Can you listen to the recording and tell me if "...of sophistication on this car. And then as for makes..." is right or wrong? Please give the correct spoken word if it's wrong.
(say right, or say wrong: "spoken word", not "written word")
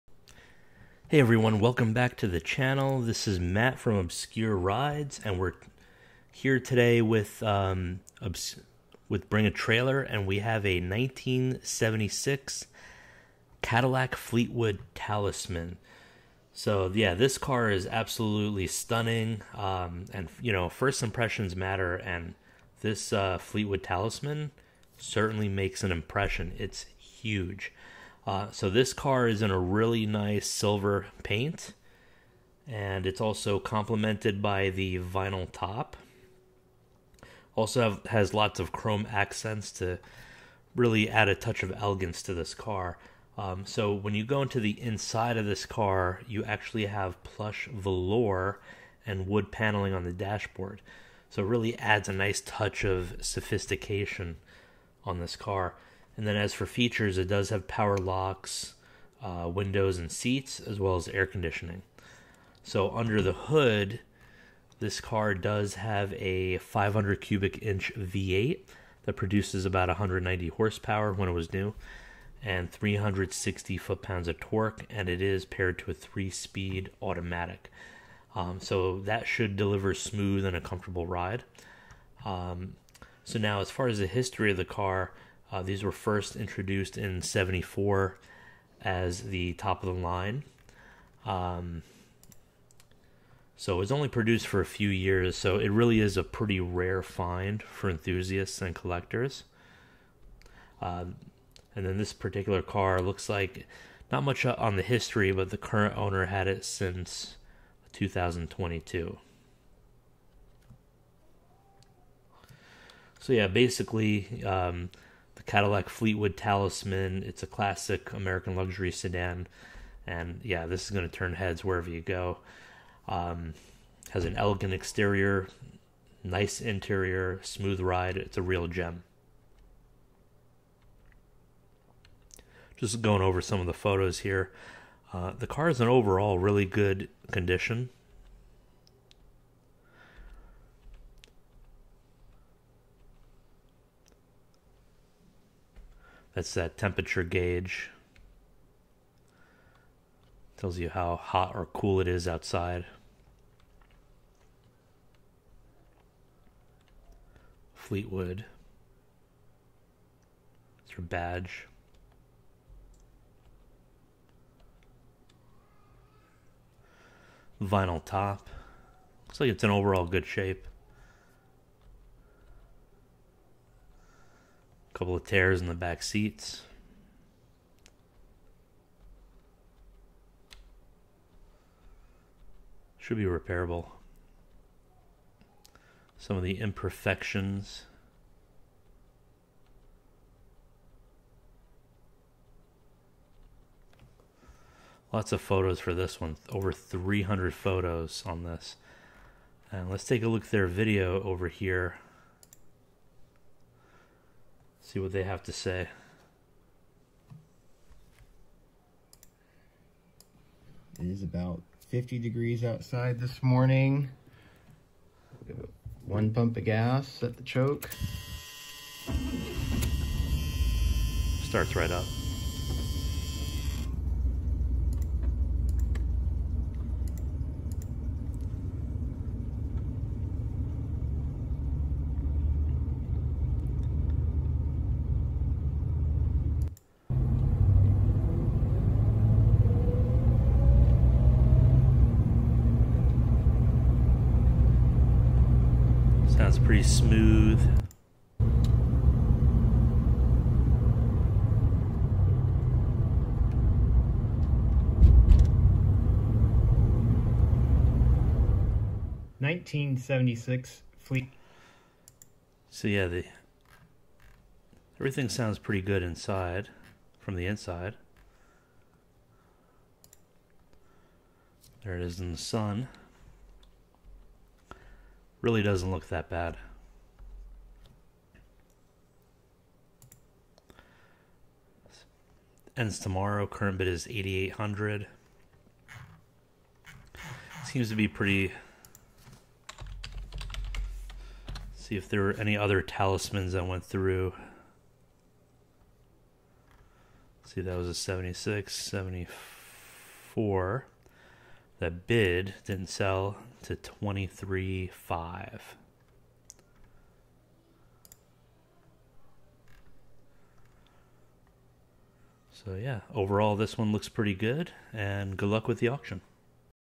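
wrong: "features", not "makes".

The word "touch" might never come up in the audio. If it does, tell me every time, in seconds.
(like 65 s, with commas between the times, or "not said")
41 s, 52 s.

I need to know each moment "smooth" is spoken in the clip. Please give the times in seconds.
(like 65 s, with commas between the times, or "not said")
79 s, 127 s, 246 s.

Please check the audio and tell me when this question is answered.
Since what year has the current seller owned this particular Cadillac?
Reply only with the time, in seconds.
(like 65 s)
107 s.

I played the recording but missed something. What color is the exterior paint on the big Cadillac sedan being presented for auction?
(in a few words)
Silver.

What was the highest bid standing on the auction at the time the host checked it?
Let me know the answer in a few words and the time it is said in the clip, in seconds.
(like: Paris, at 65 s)
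8,800, at 284 s.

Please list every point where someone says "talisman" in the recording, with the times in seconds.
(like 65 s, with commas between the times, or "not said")
14 s, 23 s, 116 s, 292 s.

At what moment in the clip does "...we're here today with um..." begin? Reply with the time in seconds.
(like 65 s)
5 s.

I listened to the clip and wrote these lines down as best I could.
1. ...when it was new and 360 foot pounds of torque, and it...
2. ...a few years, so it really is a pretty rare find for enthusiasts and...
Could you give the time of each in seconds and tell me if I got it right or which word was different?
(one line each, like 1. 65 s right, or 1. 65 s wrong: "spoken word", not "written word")
1. 71 s right
2. 94 s right.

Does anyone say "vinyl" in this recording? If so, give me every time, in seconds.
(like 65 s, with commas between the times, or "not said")
34 s, 167 s.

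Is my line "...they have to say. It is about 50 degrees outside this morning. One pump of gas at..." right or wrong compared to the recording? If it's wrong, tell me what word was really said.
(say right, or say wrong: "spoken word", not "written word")
right.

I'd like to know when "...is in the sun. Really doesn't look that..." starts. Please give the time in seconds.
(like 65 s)
272 s.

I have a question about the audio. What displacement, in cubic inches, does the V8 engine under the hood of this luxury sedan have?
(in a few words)
500.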